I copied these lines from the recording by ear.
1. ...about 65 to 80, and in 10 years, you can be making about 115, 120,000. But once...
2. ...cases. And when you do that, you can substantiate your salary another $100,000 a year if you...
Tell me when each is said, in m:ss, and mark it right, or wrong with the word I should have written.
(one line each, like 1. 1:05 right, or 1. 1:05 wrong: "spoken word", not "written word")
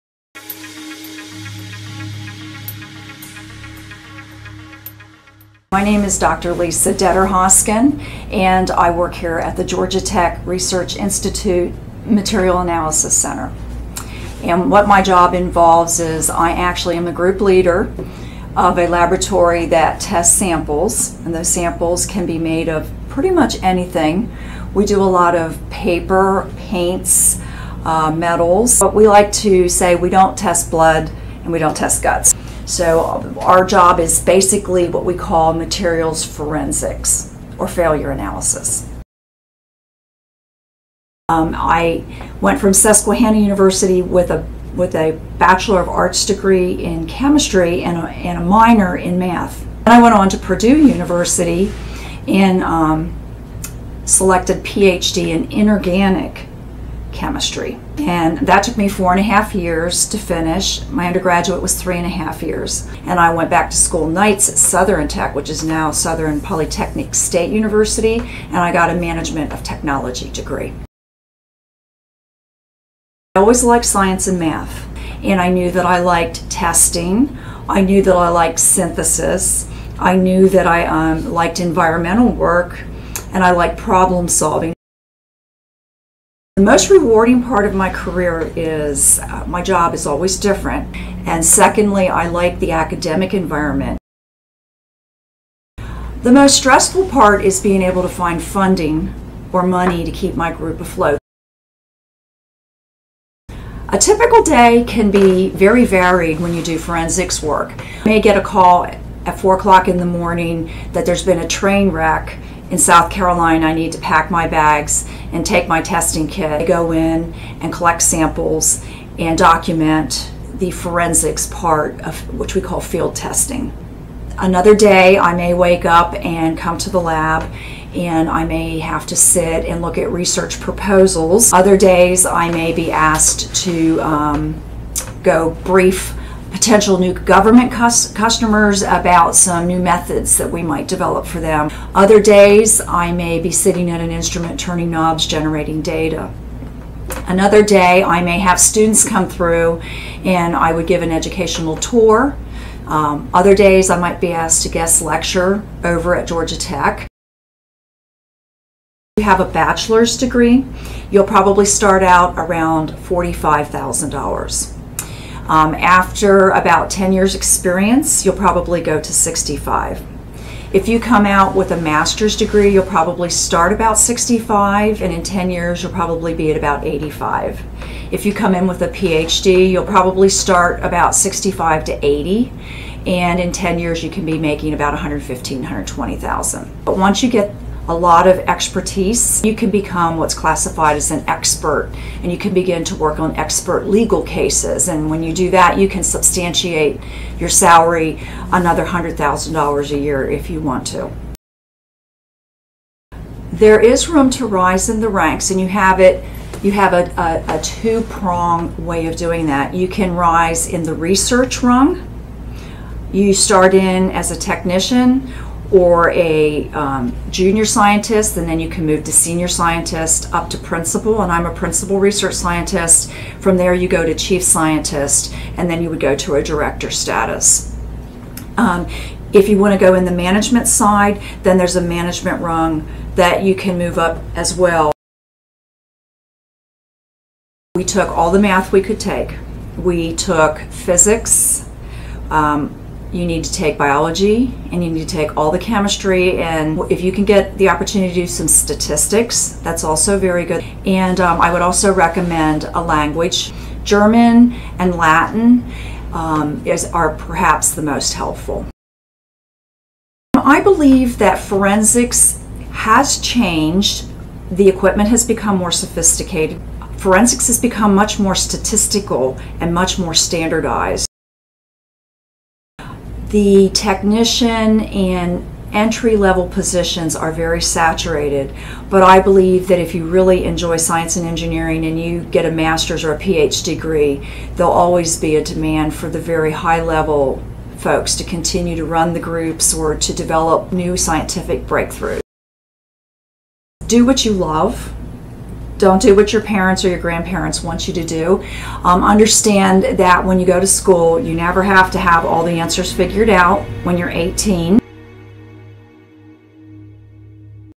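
1. 3:00 right
2. 3:14 right.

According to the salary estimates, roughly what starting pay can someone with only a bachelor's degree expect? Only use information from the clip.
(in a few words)
$45,000.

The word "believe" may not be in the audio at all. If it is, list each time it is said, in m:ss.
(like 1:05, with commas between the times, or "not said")
4:20, 4:39.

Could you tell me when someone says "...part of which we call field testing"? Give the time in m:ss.
2:01.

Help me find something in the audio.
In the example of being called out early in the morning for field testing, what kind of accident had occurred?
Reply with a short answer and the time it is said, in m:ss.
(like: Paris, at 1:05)
train wreck, at 1:51.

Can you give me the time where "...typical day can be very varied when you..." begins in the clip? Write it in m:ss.
1:43.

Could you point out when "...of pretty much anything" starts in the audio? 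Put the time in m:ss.
0:22.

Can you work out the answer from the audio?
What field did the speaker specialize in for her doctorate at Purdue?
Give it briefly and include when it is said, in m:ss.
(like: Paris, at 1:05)
inorganic chemistry, at 0:55.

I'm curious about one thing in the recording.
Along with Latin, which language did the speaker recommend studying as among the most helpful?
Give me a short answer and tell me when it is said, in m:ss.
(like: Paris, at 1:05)
German, at 4:13.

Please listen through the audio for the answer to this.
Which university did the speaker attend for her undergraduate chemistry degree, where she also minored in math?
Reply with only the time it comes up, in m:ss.
0:42.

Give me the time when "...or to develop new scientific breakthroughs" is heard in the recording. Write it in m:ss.
4:49.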